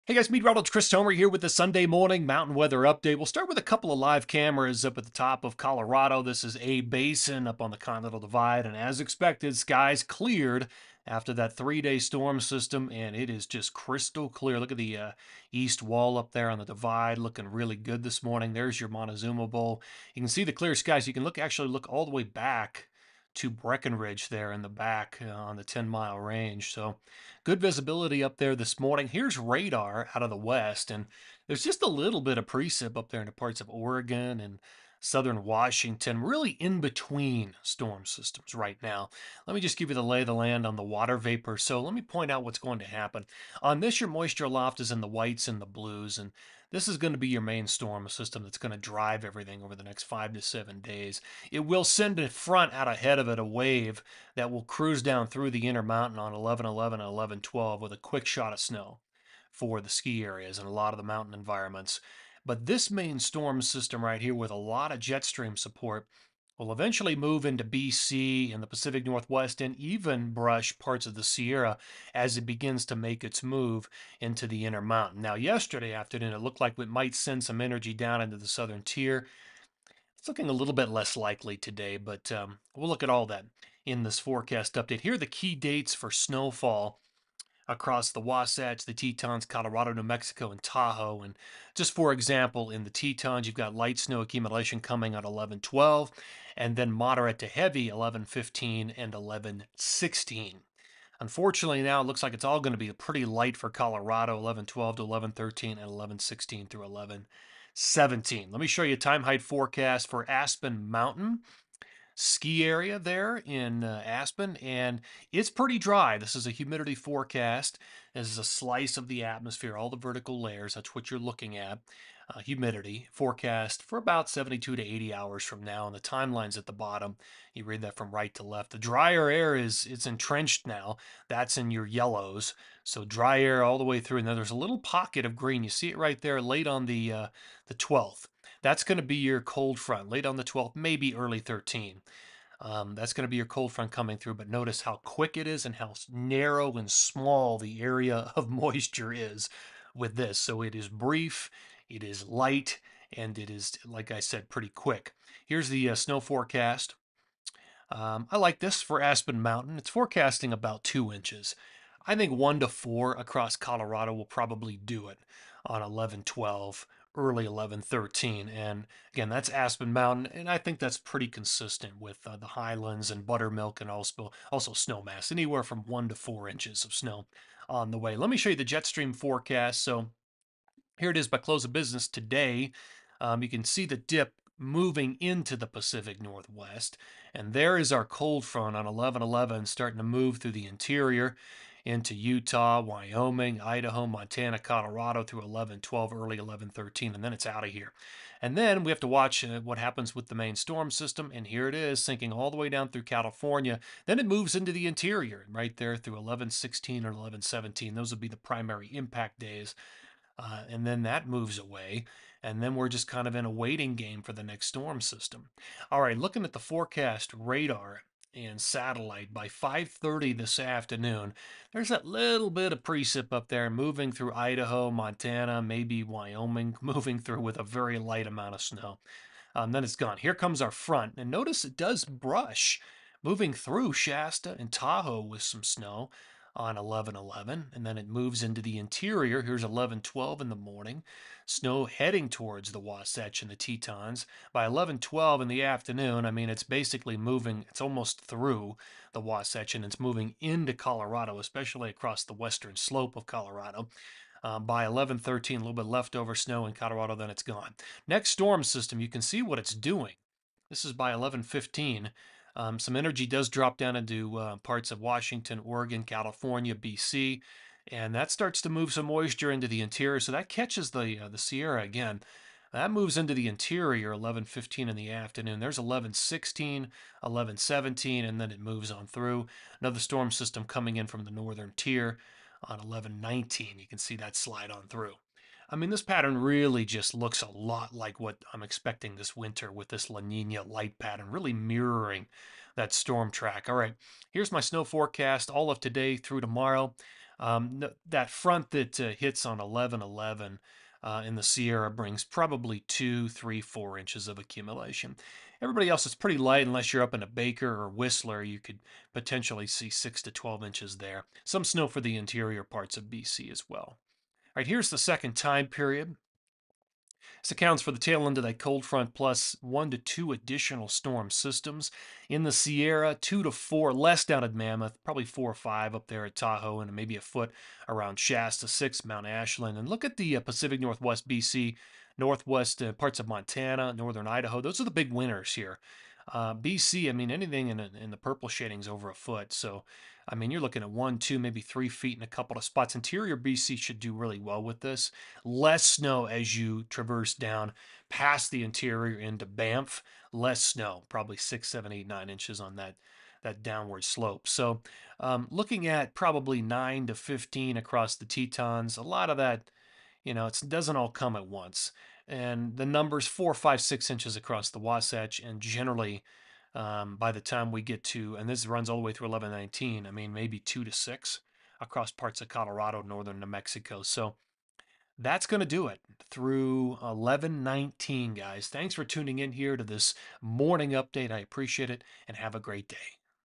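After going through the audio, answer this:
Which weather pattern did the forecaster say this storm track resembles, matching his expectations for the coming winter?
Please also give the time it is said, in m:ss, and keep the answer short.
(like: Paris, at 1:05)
La Nina light, at 4:50.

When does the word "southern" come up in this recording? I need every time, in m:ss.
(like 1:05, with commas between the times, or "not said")
0:34, 1:18.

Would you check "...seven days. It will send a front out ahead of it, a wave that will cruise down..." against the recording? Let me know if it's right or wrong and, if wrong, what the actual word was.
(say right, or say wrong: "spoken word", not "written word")
right.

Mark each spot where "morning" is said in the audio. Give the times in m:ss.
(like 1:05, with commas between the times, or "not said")
0:01, 0:18, 0:28, 4:00, 6:20.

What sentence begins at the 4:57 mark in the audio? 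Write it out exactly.
Um, that front that uh, hits on 11 11 uh, in the Sierra brings probably two, three, four inches of accumulation.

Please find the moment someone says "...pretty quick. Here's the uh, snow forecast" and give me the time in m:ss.
2:34.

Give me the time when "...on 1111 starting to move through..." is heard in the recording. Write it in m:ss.
3:08.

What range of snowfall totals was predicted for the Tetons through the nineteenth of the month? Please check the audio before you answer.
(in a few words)
9 to 15 inches.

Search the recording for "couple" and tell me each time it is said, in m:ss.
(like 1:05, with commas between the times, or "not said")
0:03, 5:42.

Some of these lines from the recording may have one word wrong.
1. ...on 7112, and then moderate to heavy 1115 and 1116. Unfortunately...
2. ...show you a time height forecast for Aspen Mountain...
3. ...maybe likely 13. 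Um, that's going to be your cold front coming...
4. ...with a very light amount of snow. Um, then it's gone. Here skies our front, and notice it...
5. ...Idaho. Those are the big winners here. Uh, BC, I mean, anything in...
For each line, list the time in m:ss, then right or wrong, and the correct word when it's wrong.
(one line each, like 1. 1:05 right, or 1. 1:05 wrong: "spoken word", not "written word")
1. 1:35 wrong: "1112", not "7112"
2. 1:48 right
3. 2:20 wrong: "early", not "likely"
4. 3:47 wrong: "comes", not "skies"
5. 5:34 right.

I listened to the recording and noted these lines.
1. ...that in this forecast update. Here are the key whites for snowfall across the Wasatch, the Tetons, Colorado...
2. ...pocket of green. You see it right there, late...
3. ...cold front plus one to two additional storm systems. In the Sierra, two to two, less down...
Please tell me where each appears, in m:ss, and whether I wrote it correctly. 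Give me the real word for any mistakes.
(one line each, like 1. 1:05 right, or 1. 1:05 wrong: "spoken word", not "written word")
1. 1:23 wrong: "dates", not "whites"
2. 2:14 right
3. 5:18 wrong: "four", not "two".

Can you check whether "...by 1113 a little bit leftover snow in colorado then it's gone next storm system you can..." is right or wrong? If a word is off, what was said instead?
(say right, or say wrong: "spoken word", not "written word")
right.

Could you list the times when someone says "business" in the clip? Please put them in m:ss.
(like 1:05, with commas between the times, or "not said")
3:01.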